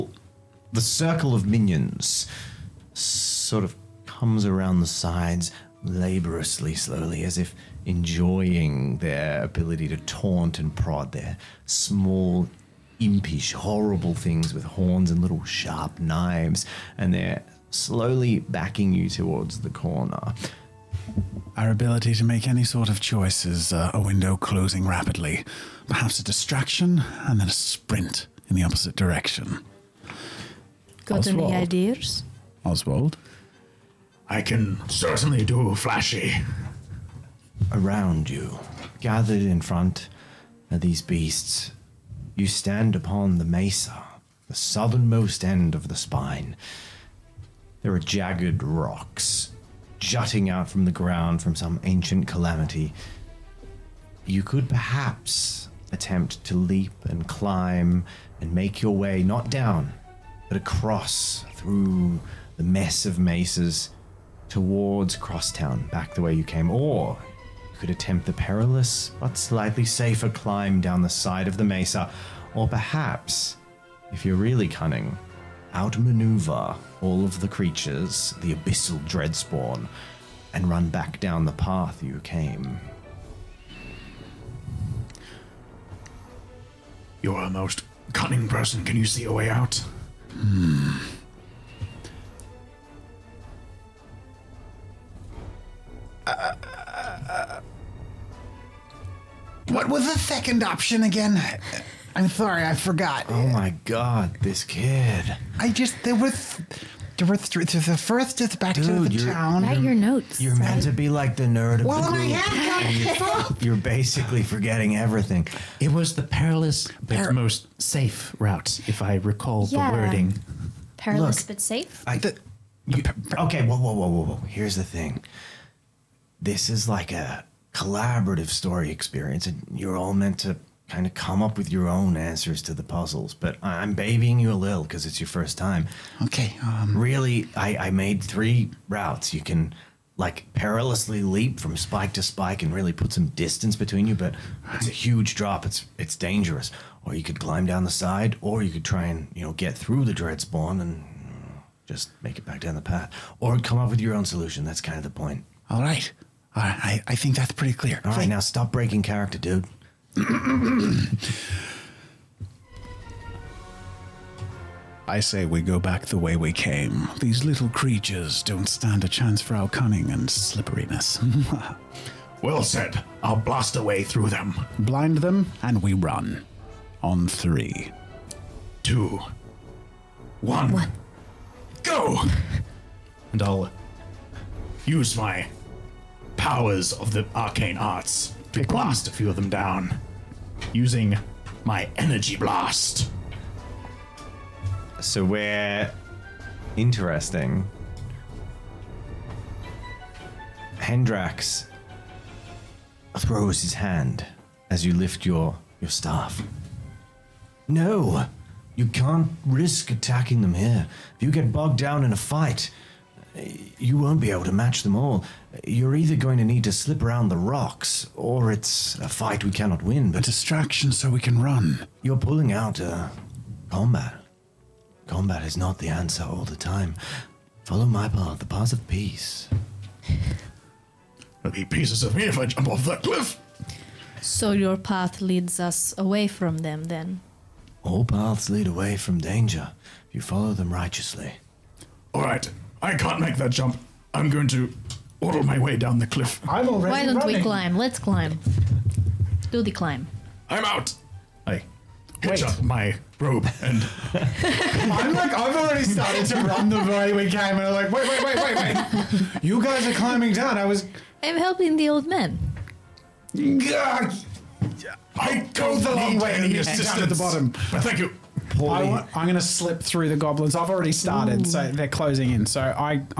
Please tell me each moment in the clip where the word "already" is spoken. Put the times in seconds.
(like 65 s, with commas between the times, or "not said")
246 s, 255 s, 270 s.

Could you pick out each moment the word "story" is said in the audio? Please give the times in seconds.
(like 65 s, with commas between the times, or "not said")
128 s.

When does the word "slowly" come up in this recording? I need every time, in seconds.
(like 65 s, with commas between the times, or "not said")
6 s, 17 s.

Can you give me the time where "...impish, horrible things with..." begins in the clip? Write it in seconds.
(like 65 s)
12 s.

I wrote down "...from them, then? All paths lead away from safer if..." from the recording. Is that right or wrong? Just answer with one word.
wrong.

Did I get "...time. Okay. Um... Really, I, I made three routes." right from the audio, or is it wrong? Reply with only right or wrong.
right.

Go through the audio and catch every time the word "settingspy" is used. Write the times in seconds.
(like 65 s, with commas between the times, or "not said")
not said.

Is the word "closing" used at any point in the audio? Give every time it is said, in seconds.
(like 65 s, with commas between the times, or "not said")
24 s, 271 s.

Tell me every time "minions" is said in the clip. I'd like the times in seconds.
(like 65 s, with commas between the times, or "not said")
1 s.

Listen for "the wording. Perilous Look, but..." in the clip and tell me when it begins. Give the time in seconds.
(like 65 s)
119 s.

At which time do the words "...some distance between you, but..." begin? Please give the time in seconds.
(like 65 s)
143 s.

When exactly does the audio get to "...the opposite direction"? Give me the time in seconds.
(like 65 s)
28 s.